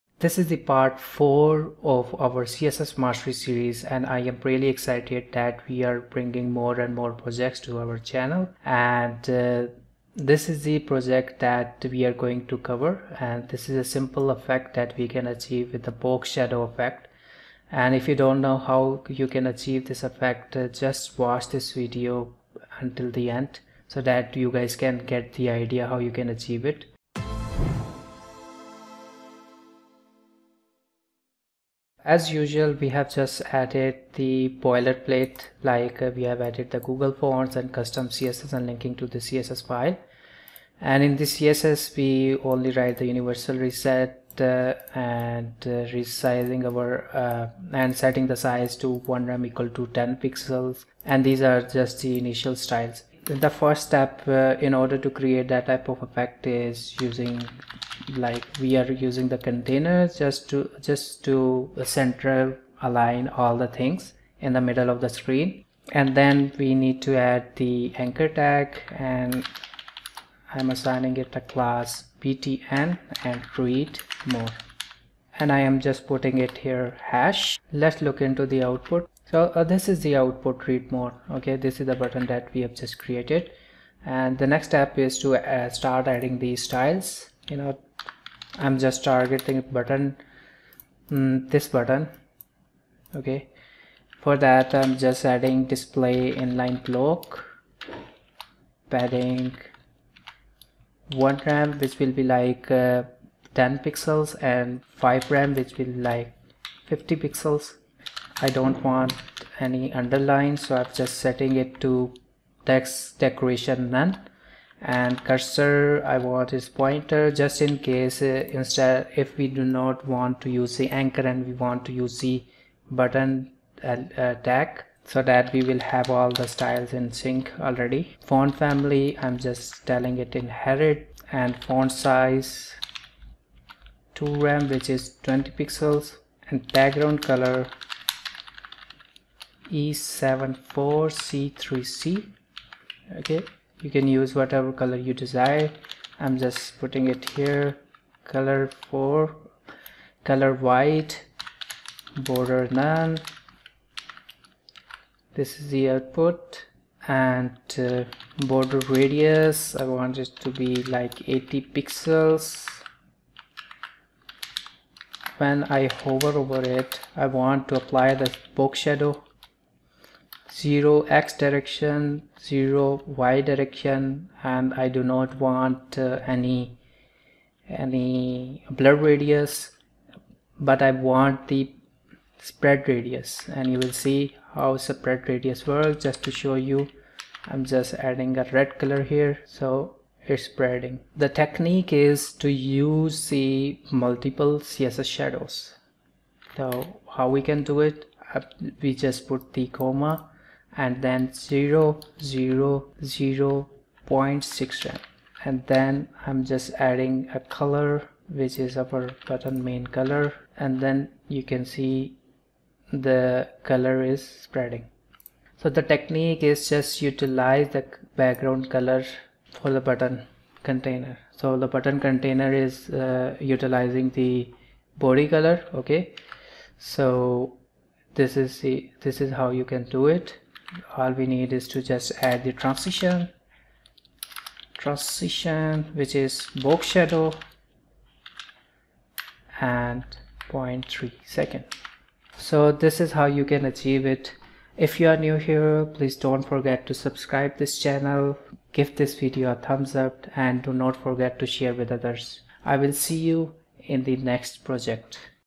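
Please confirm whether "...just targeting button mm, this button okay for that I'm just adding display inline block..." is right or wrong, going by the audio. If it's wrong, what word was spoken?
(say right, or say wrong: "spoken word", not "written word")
right.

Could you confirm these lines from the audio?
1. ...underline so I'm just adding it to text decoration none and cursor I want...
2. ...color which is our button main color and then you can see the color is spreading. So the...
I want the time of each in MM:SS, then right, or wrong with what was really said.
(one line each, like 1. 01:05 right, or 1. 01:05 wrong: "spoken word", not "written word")
1. 01:49 wrong: "setting", not "adding"
2. 03:27 right.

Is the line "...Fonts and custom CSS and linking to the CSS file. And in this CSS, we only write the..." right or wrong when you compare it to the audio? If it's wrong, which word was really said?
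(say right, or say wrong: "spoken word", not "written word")
right.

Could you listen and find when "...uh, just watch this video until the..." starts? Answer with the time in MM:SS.
00:20.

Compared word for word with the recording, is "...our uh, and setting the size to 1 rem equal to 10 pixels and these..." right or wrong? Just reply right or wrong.
right.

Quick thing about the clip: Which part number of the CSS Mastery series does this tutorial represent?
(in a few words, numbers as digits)
4.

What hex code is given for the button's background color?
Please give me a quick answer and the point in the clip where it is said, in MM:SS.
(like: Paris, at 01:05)
E74C3C, at 02:19.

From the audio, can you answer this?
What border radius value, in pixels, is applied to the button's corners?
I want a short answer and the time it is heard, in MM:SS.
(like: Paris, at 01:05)
80 pixels, at 02:41.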